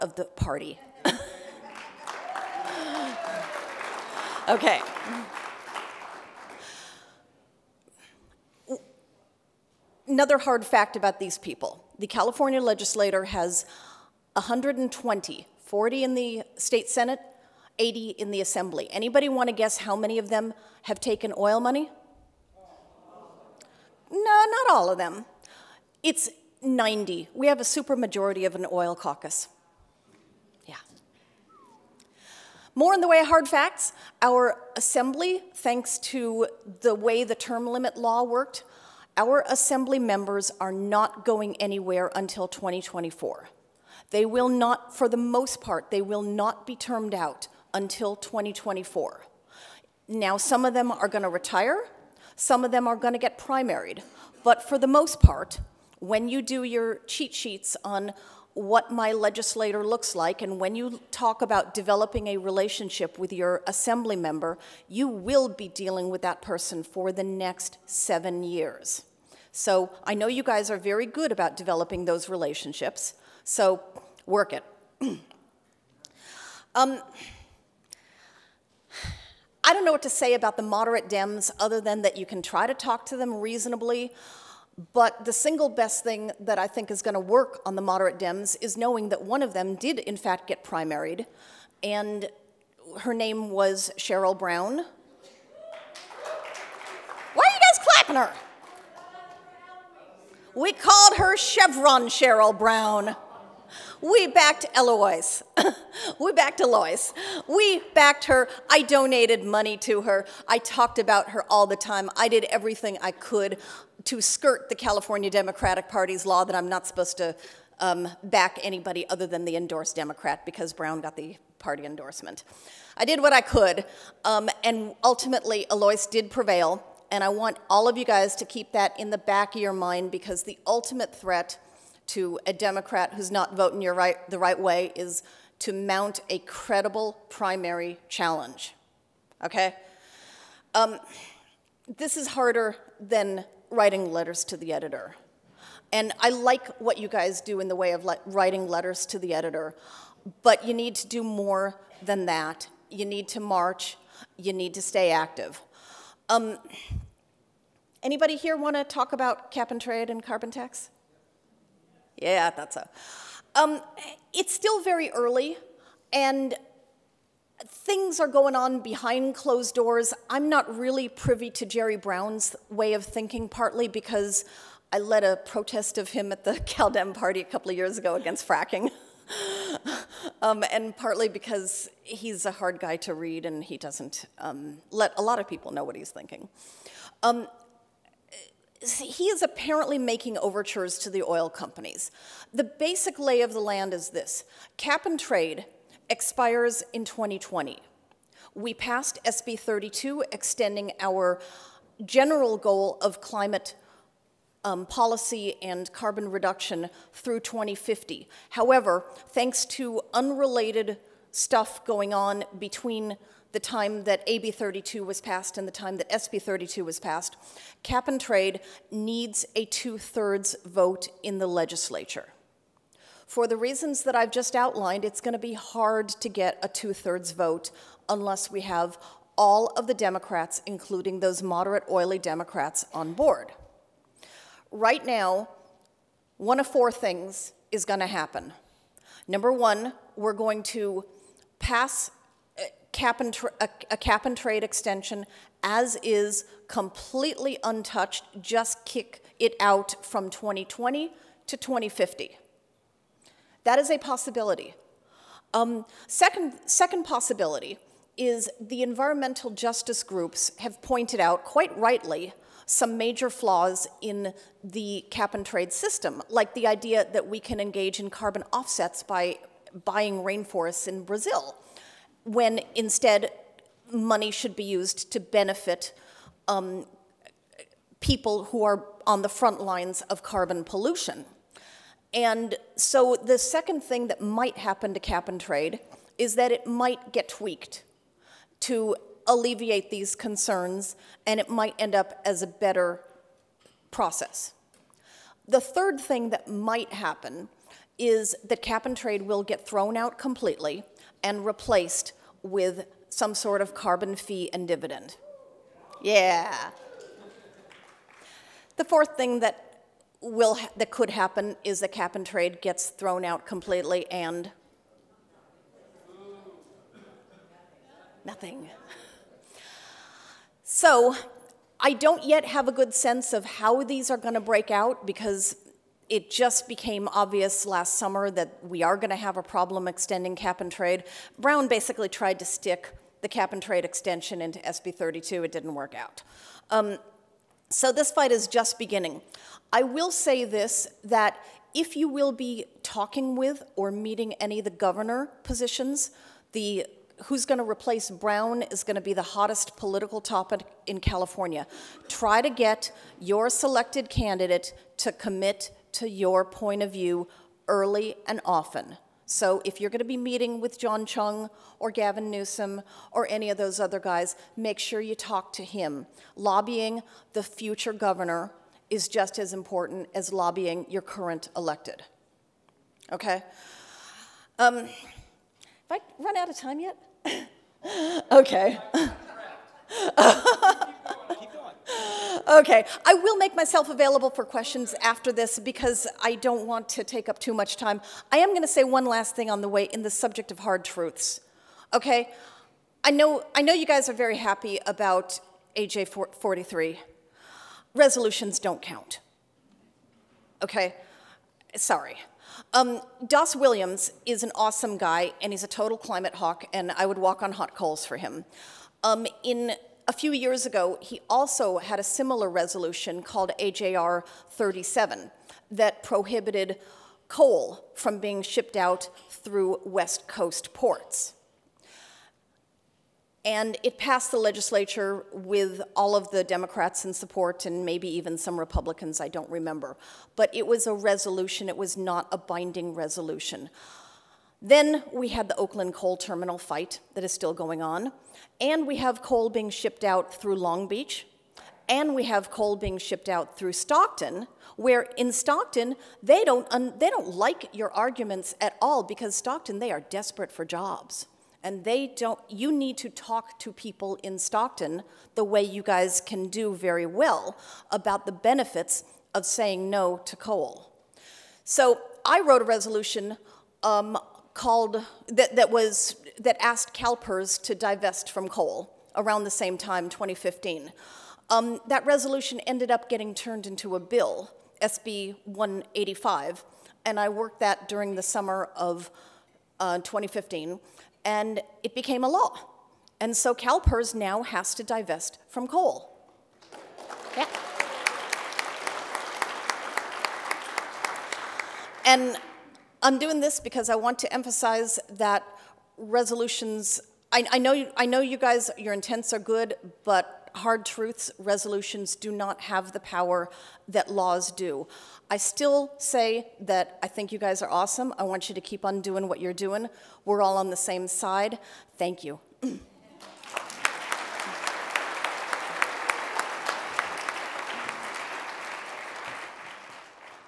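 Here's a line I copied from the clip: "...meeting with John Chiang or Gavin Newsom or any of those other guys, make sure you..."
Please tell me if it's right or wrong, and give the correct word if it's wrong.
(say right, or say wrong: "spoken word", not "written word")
right.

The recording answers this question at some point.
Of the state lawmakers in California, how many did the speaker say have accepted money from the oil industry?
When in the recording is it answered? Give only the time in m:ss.
0:26.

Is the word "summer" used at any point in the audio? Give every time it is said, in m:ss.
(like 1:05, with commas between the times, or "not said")
5:27, 7:58.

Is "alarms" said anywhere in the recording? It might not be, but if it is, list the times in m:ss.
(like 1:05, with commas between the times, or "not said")
not said.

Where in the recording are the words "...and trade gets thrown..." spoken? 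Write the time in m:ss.
5:12.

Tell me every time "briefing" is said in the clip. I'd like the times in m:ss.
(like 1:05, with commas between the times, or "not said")
not said.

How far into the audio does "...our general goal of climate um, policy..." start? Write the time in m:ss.
3:20.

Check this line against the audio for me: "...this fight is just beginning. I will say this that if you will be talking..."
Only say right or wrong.
right.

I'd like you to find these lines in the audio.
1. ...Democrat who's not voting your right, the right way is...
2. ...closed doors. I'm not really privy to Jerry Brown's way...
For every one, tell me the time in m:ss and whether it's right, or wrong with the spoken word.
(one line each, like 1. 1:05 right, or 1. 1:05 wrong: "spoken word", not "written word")
1. 2:12 right
2. 2:49 right.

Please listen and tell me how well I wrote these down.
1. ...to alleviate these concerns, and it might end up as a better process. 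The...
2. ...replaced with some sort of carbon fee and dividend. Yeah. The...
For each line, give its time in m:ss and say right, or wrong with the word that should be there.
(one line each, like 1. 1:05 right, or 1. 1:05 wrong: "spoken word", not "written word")
1. 4:48 right
2. 5:01 right.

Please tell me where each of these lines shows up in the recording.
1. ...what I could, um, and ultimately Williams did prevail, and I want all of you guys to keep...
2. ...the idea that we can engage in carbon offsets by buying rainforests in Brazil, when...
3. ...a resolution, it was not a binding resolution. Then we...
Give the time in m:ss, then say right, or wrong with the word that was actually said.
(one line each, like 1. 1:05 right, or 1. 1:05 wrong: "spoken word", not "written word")
1. 2:03 wrong: "Eloise", not "Williams"
2. 4:26 right
3. 7:10 right.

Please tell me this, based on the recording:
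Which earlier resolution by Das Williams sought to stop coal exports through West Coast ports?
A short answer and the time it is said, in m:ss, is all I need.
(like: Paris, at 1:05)
AJR 37, at 6:53.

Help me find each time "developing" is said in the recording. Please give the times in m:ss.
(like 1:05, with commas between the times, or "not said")
1:01, 1:11.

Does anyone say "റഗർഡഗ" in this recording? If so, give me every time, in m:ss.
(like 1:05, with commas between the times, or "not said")
not said.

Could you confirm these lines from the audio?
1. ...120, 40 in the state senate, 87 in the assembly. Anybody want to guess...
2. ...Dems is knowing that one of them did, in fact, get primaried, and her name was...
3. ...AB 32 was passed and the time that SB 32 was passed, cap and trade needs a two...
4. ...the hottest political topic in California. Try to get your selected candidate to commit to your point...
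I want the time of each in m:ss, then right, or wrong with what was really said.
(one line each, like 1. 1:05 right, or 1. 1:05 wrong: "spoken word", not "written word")
1. 0:14 wrong: "80", not "87"
2. 1:28 right
3. 3:34 right
4. 5:49 right.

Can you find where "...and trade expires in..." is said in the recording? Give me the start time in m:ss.
3:15.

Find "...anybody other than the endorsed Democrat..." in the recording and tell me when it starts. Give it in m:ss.
1:58.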